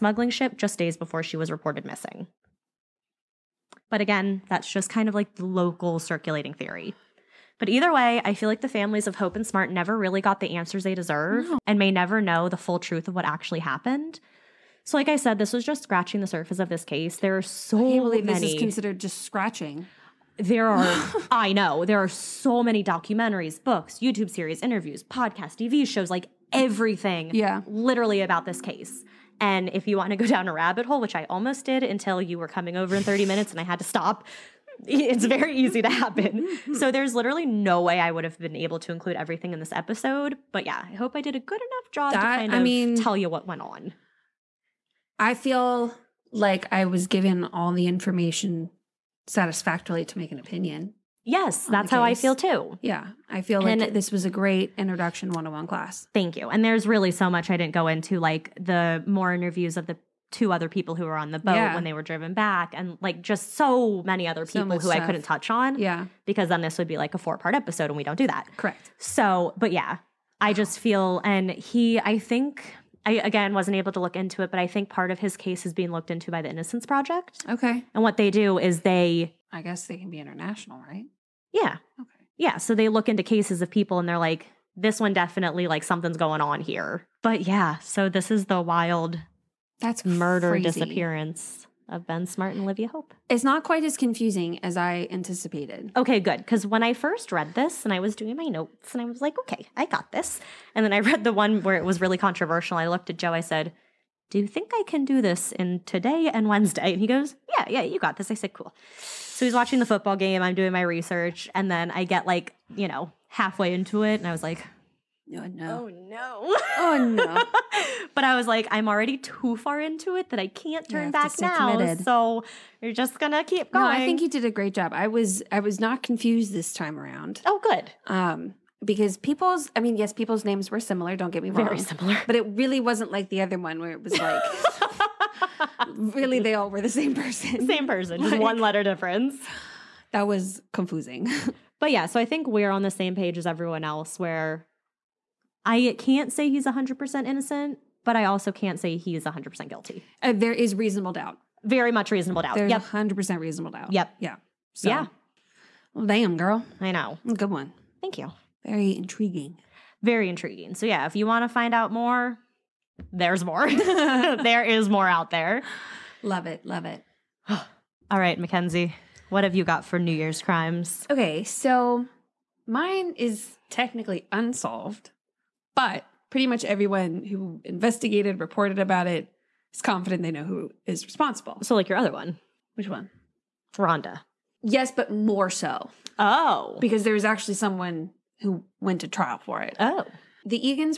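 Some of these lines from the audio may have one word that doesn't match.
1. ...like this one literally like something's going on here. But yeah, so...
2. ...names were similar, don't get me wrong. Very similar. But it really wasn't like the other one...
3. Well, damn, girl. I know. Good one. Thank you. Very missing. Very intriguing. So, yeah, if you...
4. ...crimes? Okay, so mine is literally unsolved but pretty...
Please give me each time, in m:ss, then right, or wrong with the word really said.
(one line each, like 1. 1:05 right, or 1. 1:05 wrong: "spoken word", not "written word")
1. 1:24 wrong: "definitely", not "literally"
2. 2:10 right
3. 2:35 wrong: "intriguing", not "missing"
4. 2:50 wrong: "technically", not "literally".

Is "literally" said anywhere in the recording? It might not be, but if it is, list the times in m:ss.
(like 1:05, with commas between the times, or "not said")
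0:27, 0:37.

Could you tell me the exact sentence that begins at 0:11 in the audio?
and may never know the full truth of what actually happened.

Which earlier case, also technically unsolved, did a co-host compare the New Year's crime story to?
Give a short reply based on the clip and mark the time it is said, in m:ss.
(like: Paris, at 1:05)
Rhonda, at 3:03.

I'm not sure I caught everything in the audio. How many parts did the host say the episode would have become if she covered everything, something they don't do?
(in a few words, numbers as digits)
4.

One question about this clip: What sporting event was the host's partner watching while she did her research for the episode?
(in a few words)
the football game.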